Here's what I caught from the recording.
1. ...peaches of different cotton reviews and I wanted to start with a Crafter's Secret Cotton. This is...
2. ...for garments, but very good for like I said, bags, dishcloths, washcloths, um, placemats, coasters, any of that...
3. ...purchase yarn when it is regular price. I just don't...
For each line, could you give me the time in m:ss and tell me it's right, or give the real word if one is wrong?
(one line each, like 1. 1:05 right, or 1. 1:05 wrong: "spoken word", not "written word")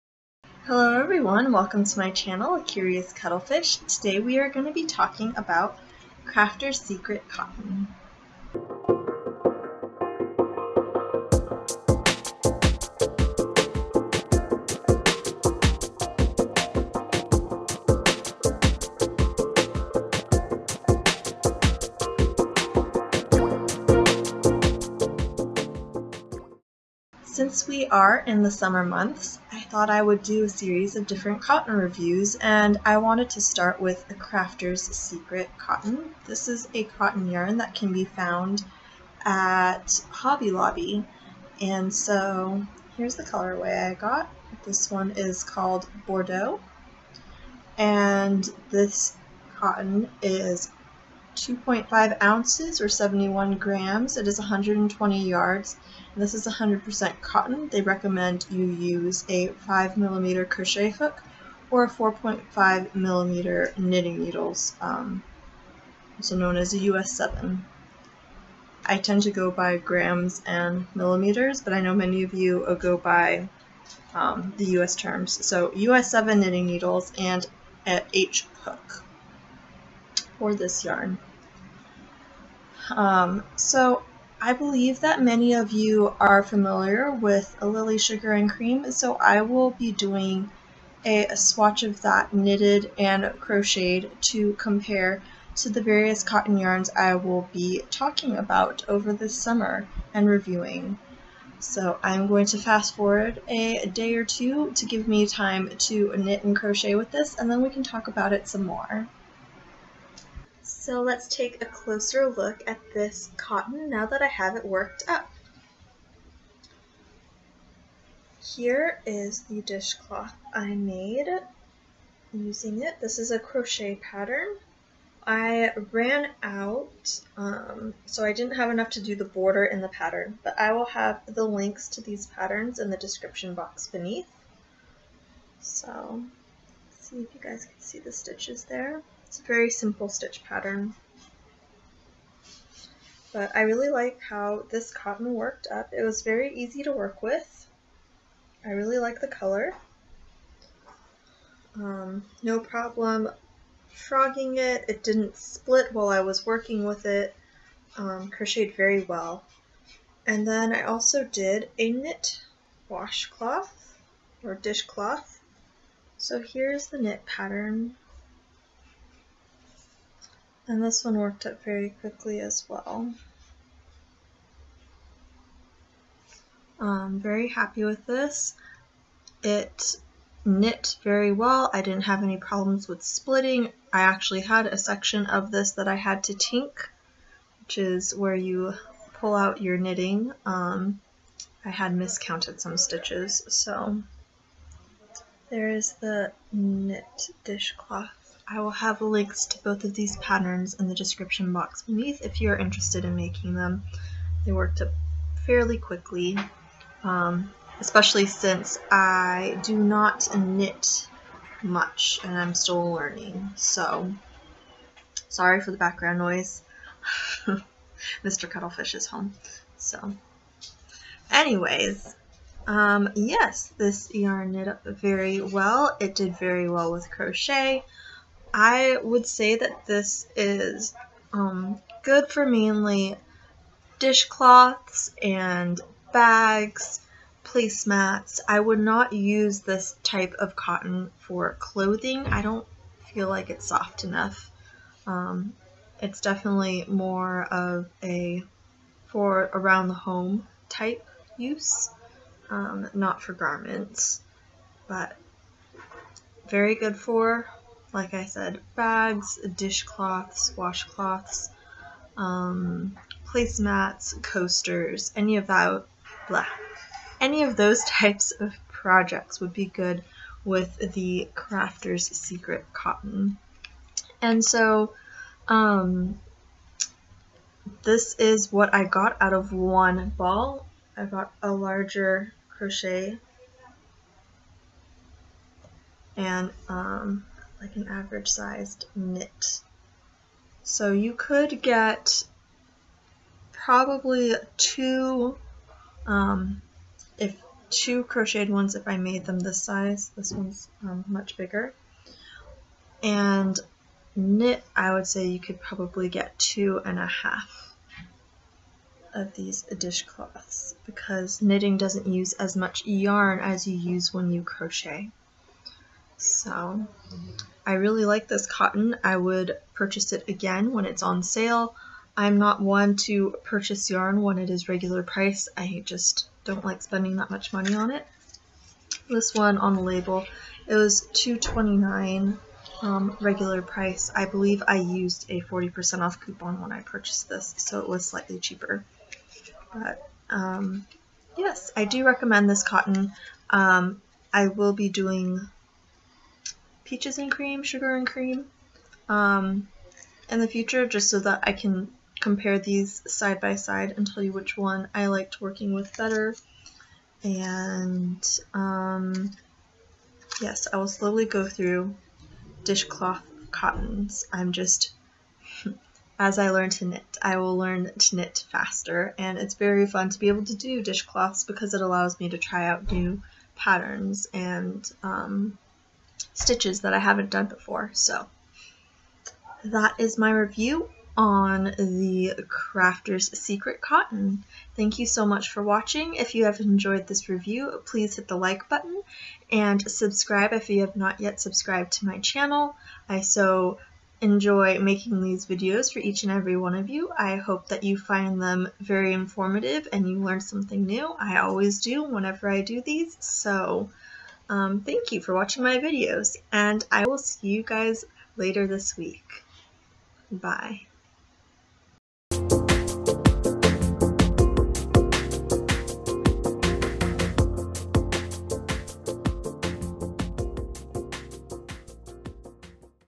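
1. 0:30 wrong: "series", not "peaches"
2. 4:13 right
3. 5:23 right.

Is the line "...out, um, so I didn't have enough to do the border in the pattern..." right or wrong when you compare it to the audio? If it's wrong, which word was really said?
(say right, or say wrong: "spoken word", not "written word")
right.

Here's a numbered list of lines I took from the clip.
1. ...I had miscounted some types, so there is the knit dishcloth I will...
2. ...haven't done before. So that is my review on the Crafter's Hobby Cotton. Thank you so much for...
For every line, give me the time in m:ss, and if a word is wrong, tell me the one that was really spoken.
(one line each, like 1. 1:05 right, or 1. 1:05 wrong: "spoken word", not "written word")
1. 3:11 wrong: "stitches", not "types"
2. 6:16 wrong: "Secret", not "Hobby".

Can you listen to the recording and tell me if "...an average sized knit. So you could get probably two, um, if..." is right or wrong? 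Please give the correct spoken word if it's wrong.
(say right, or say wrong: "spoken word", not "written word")
right.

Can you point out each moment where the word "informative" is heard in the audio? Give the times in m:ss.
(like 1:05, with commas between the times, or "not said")
6:39.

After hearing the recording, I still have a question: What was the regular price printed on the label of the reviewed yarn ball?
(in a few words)
$2.29.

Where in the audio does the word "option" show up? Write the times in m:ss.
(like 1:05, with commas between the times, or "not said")
not said.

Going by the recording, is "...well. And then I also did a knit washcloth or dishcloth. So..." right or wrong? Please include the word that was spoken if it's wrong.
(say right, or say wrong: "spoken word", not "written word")
right.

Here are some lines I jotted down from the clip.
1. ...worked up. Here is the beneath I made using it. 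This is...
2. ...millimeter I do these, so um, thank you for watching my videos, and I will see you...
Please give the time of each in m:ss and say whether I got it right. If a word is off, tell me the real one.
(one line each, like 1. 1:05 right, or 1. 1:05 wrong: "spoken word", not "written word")
1. 1:54 wrong: "dishcloth", not "beneath"
2. 6:42 wrong: "whenever", not "millimeter".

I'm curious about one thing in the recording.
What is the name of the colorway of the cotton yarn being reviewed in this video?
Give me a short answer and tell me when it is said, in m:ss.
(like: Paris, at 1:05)
Bordeaux, at 0:46.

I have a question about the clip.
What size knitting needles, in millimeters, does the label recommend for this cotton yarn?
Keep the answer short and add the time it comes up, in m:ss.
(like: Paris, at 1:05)
4.5 millimeter, at 1:01.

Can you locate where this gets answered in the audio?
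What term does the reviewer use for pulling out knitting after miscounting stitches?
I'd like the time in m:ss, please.
3:06.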